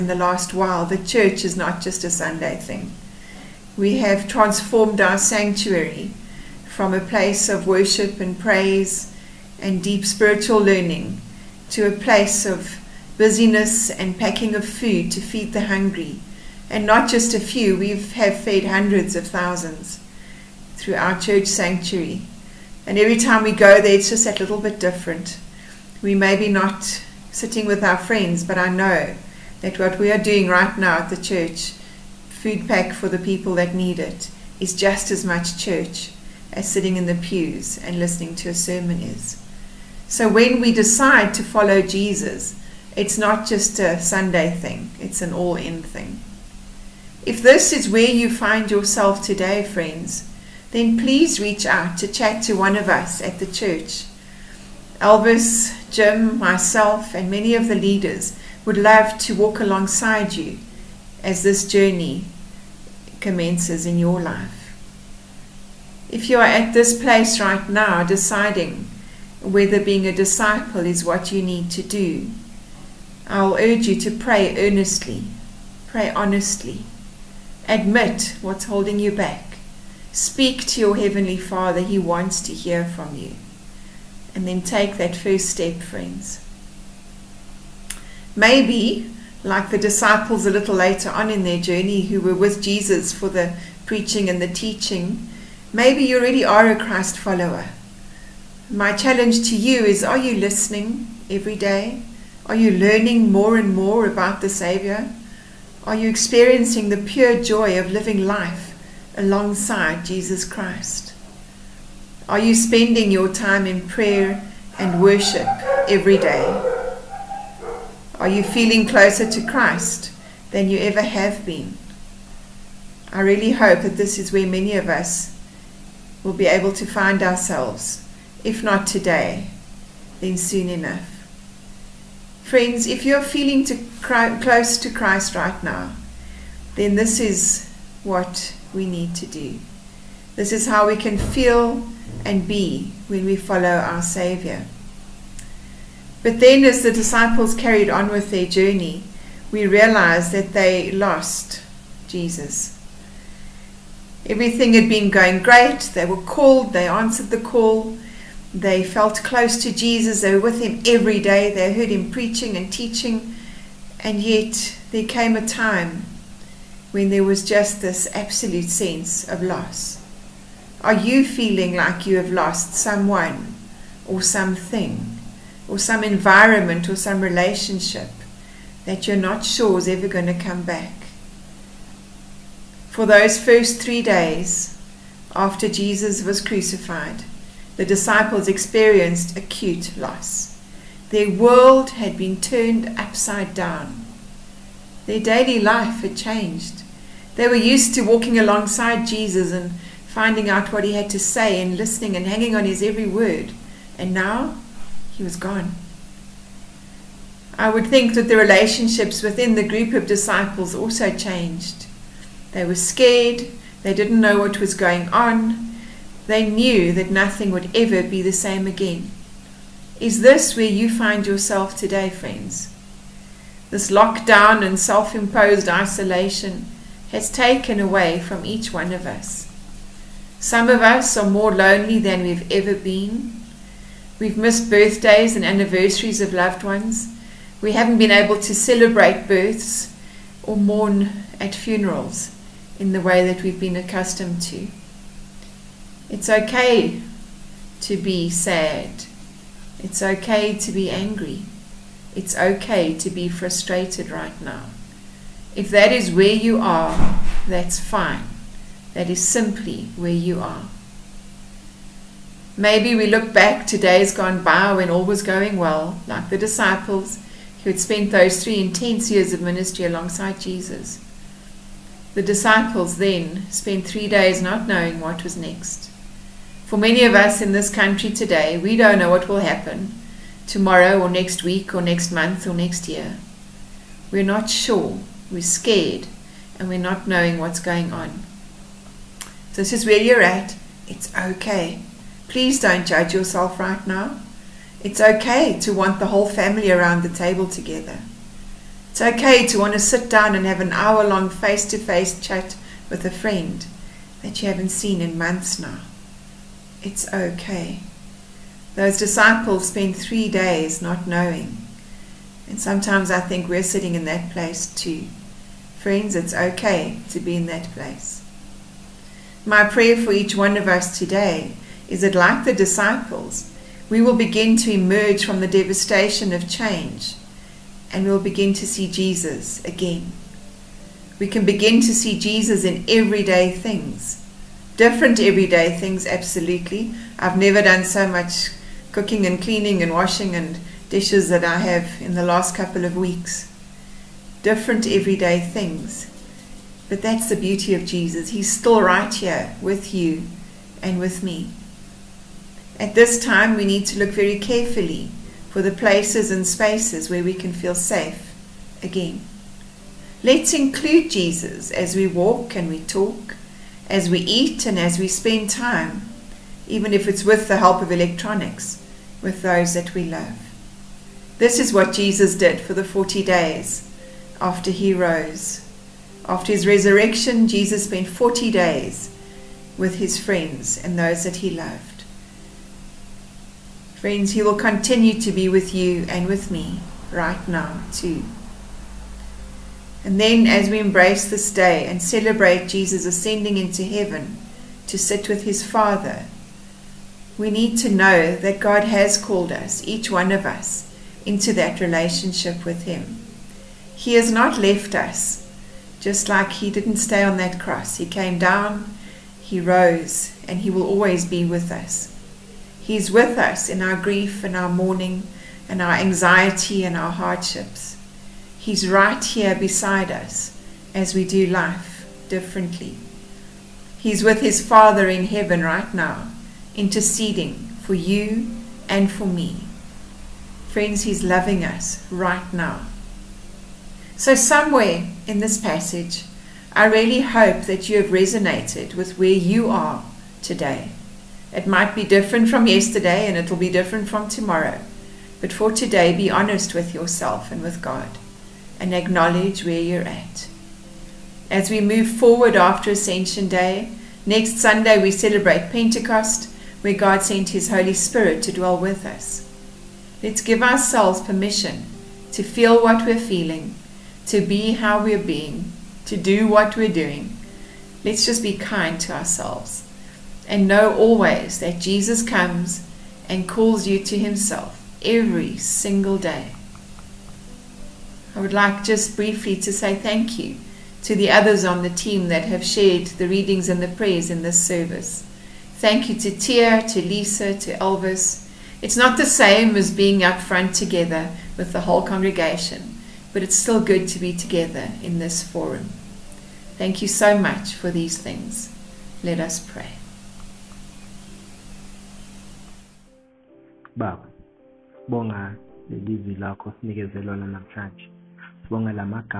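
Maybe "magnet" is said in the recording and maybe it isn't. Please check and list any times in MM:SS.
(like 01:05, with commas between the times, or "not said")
not said.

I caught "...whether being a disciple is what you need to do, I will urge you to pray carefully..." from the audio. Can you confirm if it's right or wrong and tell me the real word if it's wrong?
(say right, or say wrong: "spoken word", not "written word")
wrong: "earnestly", not "carefully".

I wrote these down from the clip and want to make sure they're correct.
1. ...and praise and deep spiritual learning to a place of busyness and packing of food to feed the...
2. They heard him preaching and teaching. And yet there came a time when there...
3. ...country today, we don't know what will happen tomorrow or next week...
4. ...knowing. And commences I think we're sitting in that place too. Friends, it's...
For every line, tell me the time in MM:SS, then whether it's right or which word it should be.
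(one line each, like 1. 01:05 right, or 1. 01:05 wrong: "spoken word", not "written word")
1. 00:08 right
2. 02:41 right
3. 04:37 right
4. 05:11 wrong: "sometimes", not "commences".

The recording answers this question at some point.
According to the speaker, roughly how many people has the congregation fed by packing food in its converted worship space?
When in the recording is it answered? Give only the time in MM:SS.
00:18.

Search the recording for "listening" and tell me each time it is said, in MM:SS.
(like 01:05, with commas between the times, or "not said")
00:37, 01:40, 03:21.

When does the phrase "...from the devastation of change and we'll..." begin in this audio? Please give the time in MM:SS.
05:25.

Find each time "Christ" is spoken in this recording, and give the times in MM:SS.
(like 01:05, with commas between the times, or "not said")
01:36, 01:50, 01:59, 02:14.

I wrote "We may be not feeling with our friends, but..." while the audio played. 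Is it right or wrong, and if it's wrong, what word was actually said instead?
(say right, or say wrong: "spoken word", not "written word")
wrong: "sitting", not "feeling".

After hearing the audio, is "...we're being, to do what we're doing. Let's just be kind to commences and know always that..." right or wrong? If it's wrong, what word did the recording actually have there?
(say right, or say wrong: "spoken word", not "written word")
wrong: "ourselves", not "commences".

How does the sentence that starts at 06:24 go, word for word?
Friends, He will continue to be with you and with me right now, too.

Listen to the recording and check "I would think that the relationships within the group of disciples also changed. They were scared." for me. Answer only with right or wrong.
right.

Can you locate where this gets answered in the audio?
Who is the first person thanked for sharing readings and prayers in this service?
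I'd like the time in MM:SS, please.
08:06.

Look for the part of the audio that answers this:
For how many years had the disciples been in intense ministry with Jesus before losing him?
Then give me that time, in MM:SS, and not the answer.
04:28.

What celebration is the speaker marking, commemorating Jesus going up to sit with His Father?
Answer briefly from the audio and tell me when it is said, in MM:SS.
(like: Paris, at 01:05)
Ascension Day, at 07:32.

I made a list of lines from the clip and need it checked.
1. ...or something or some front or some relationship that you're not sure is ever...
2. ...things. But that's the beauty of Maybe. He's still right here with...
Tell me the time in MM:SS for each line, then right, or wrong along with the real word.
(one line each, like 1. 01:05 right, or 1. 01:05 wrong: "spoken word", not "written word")
1. 02:54 wrong: "environment", not "front"
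2. 05:45 wrong: "Jesus", not "Maybe".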